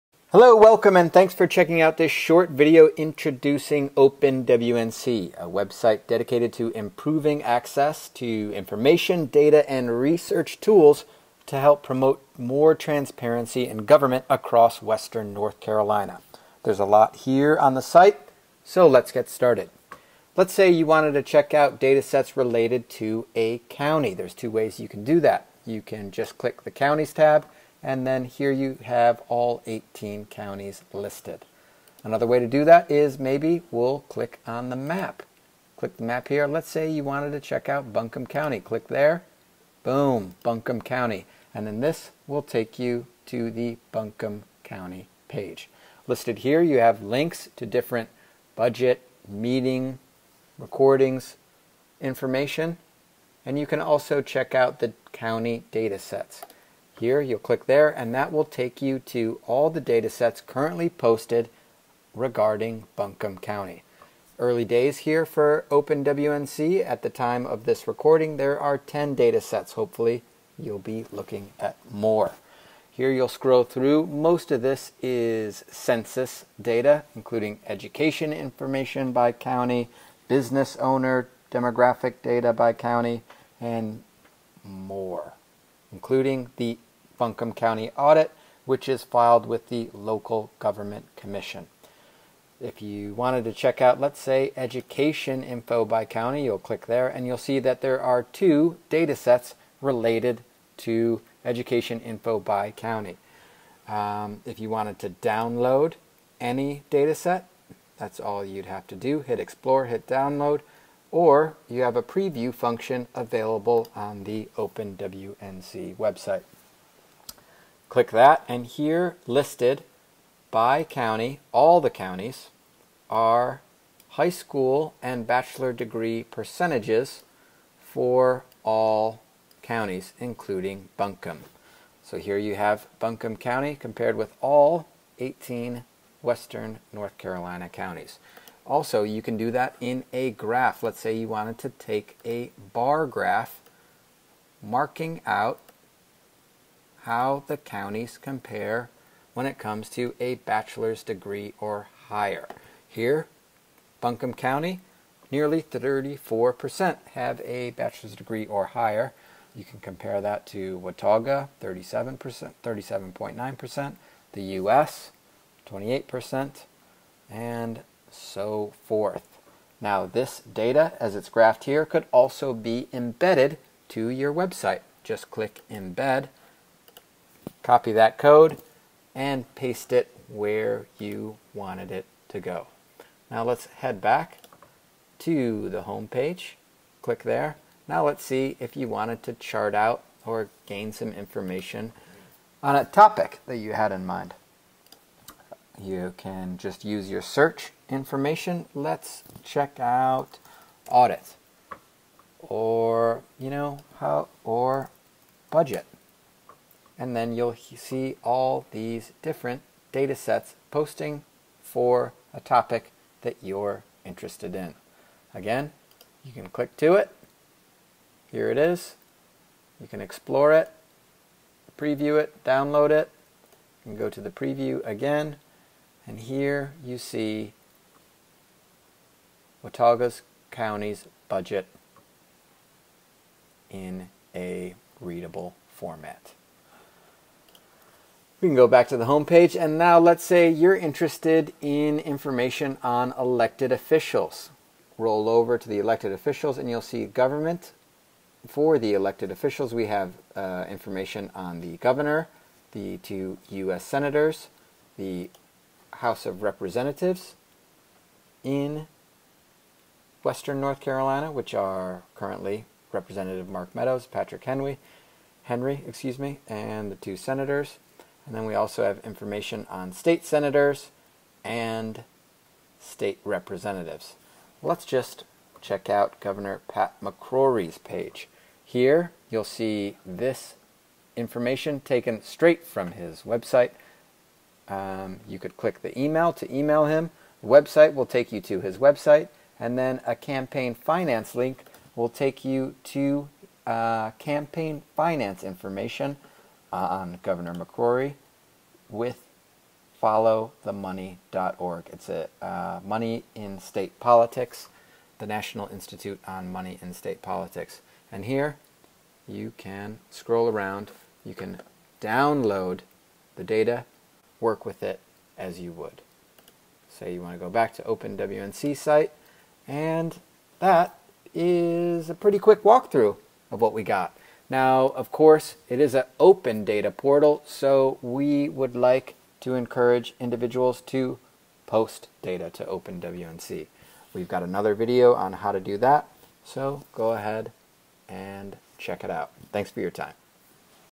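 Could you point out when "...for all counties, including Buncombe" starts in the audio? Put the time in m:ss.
2:07.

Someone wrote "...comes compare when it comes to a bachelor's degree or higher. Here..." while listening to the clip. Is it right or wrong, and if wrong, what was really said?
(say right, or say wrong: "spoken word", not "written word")
wrong: "counties", not "comes".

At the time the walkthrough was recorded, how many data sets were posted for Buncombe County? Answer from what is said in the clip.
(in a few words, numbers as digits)
10.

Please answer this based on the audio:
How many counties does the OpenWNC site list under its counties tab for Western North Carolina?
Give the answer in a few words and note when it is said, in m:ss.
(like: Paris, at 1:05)
18, at 0:29.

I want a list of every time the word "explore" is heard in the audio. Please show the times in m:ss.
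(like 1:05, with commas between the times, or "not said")
1:49, 3:39.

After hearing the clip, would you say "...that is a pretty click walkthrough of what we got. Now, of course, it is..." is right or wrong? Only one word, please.
wrong.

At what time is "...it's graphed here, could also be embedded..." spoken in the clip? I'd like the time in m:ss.
2:51.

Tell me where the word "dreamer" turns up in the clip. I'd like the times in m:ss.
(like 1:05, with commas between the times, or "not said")
not said.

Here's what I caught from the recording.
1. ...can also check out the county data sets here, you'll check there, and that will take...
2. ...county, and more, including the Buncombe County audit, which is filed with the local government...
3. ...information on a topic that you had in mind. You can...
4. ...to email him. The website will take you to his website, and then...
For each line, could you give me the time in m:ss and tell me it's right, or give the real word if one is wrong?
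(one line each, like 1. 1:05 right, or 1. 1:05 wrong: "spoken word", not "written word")
1. 0:53 wrong: "click", not "check"
2. 1:22 right
3. 3:11 right
4. 4:46 right.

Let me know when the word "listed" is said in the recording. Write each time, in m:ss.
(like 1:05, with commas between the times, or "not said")
0:30, 0:46, 1:59.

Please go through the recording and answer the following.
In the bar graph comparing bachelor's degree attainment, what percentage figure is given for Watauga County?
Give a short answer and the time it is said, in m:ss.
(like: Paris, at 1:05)
37.9%, at 2:42.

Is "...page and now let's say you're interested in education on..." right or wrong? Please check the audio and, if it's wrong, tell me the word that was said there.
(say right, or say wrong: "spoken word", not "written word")
wrong: "information", not "education".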